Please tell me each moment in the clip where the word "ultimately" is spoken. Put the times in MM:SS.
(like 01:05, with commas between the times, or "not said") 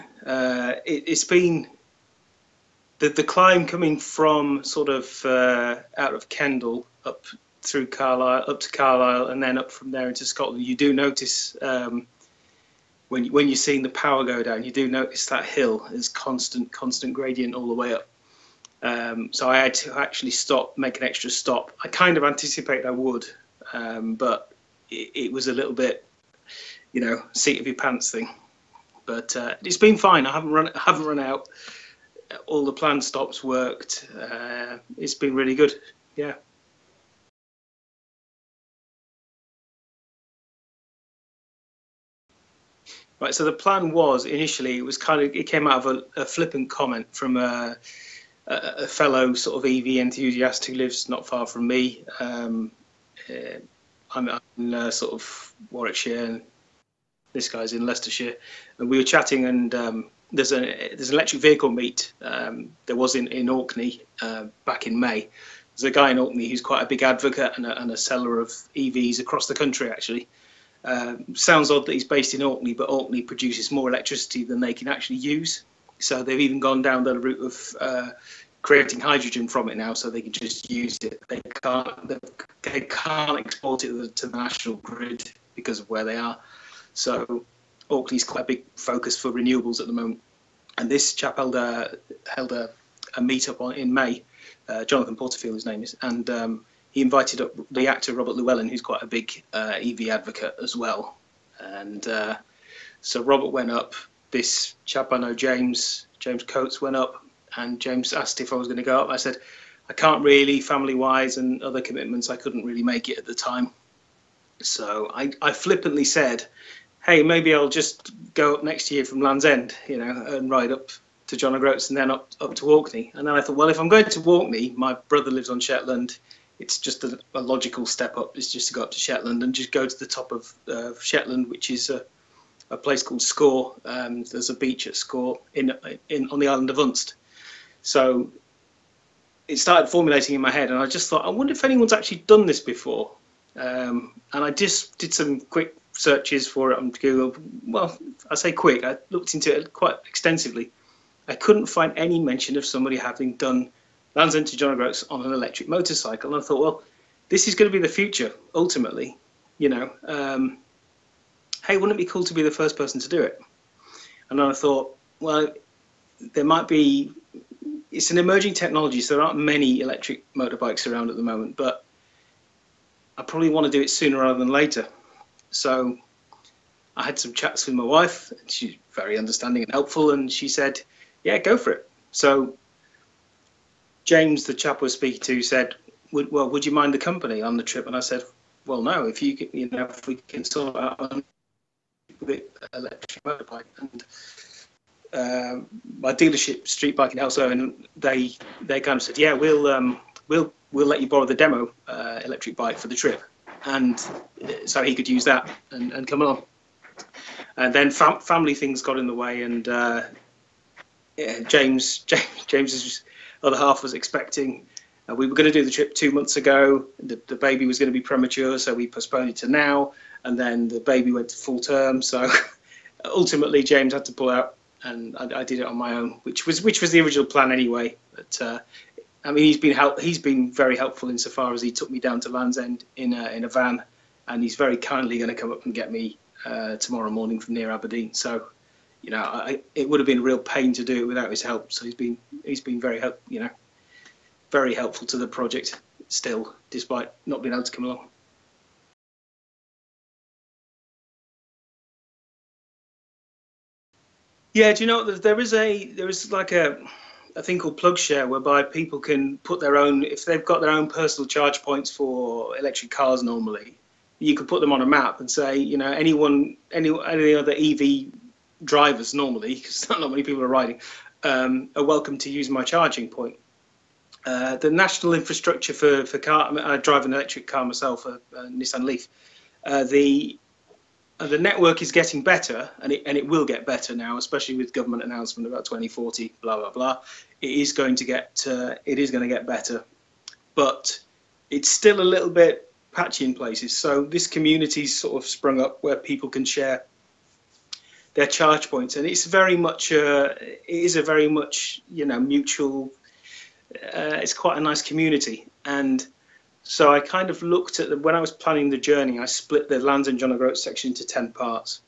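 02:38, 03:43.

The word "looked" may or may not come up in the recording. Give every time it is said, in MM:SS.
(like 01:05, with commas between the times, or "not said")
02:29, 05:07.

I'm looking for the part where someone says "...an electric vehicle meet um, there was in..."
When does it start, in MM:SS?
01:01.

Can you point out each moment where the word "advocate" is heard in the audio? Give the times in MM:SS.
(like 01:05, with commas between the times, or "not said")
01:07, 01:40.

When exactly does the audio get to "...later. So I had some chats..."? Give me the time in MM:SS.
02:54.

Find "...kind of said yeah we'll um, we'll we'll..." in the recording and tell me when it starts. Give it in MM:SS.
03:18.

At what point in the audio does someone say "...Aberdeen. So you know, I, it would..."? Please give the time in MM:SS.
03:57.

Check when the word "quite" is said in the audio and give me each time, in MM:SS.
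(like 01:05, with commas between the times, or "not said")
01:06, 01:28, 01:38, 02:29, 05:04.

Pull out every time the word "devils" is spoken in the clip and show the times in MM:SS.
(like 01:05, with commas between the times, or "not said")
not said.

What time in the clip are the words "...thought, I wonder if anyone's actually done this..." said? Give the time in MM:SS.
02:21.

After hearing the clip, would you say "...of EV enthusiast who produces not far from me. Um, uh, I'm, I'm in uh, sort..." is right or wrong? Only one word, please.
wrong.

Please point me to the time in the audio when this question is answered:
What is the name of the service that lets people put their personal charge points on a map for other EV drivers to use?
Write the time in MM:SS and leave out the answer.
04:17.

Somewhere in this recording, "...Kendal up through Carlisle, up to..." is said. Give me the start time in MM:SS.
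00:06.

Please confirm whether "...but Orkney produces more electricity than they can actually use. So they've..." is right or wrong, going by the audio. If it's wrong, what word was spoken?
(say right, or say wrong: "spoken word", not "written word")
right.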